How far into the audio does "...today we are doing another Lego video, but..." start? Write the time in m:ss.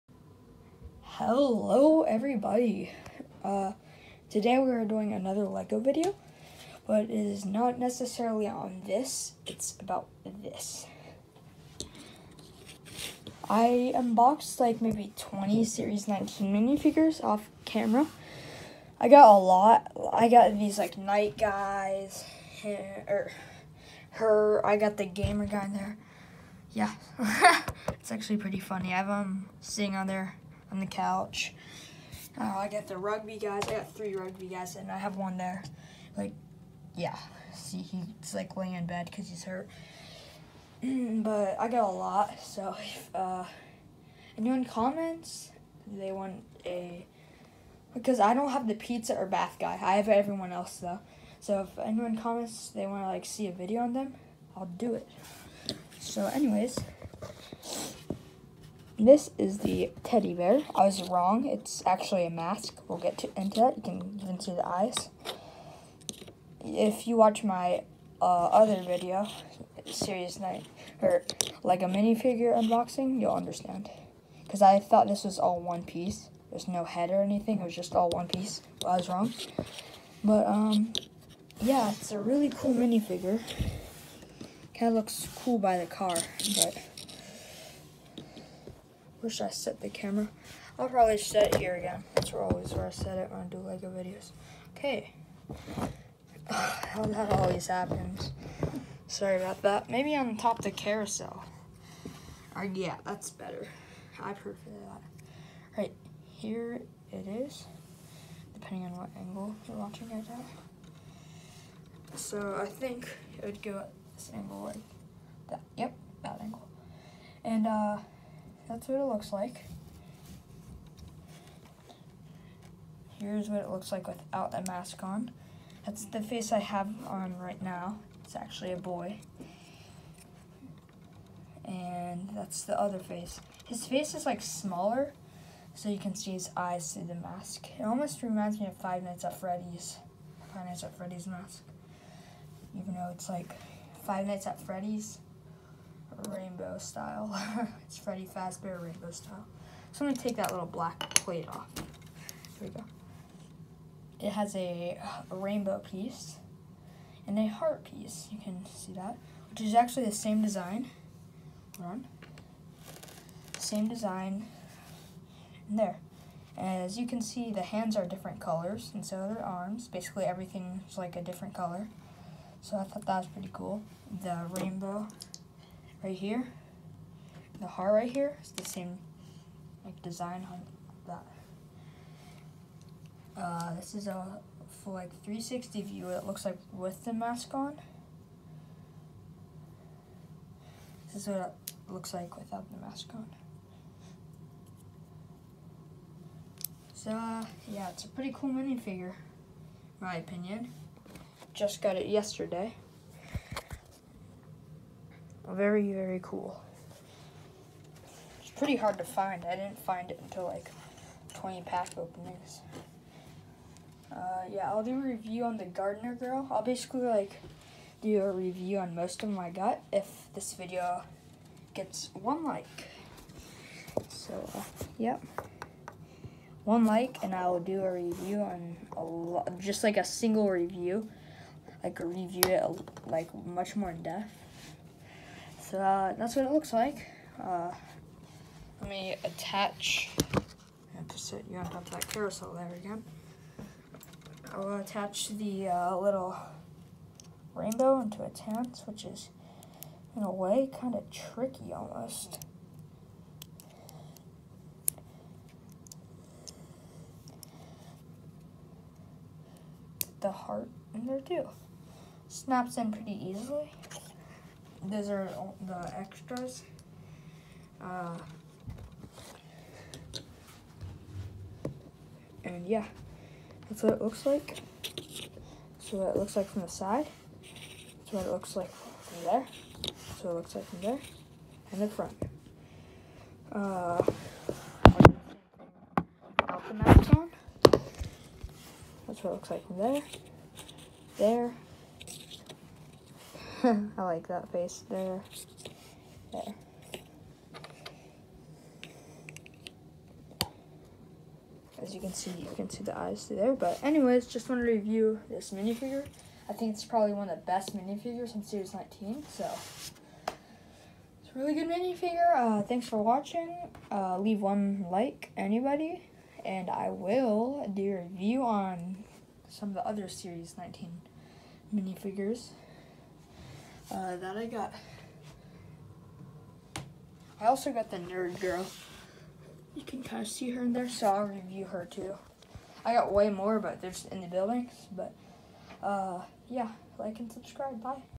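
0:04.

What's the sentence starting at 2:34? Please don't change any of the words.
It has a, a rainbow piece and a heart piece.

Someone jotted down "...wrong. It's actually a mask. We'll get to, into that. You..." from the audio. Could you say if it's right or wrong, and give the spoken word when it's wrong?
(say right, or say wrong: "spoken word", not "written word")
right.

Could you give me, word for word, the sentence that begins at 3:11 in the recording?
This is what it looks like without the mask on.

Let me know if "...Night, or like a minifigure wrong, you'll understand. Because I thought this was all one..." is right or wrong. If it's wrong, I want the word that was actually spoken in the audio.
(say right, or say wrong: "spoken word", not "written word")
wrong: "unboxing", not "wrong".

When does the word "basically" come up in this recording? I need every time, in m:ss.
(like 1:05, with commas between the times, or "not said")
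2:49, 3:36.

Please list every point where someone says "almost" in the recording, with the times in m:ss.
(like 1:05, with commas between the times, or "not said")
2:17, 4:11.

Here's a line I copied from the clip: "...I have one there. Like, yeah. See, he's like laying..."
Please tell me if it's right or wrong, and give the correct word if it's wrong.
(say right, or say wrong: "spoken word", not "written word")
right.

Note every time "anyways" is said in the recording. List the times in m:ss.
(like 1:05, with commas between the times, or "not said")
0:56, 5:03.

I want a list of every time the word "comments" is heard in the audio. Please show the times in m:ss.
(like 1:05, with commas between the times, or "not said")
0:44, 0:52.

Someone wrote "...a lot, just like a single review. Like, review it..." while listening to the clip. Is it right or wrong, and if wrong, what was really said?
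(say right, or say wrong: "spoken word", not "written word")
right.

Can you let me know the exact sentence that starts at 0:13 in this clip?
I unboxed like maybe 20 Series 19 minifigures off camera.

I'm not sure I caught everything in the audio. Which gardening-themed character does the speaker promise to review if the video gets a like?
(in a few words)
Gardener Girl.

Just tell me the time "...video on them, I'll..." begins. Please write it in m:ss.
0:53.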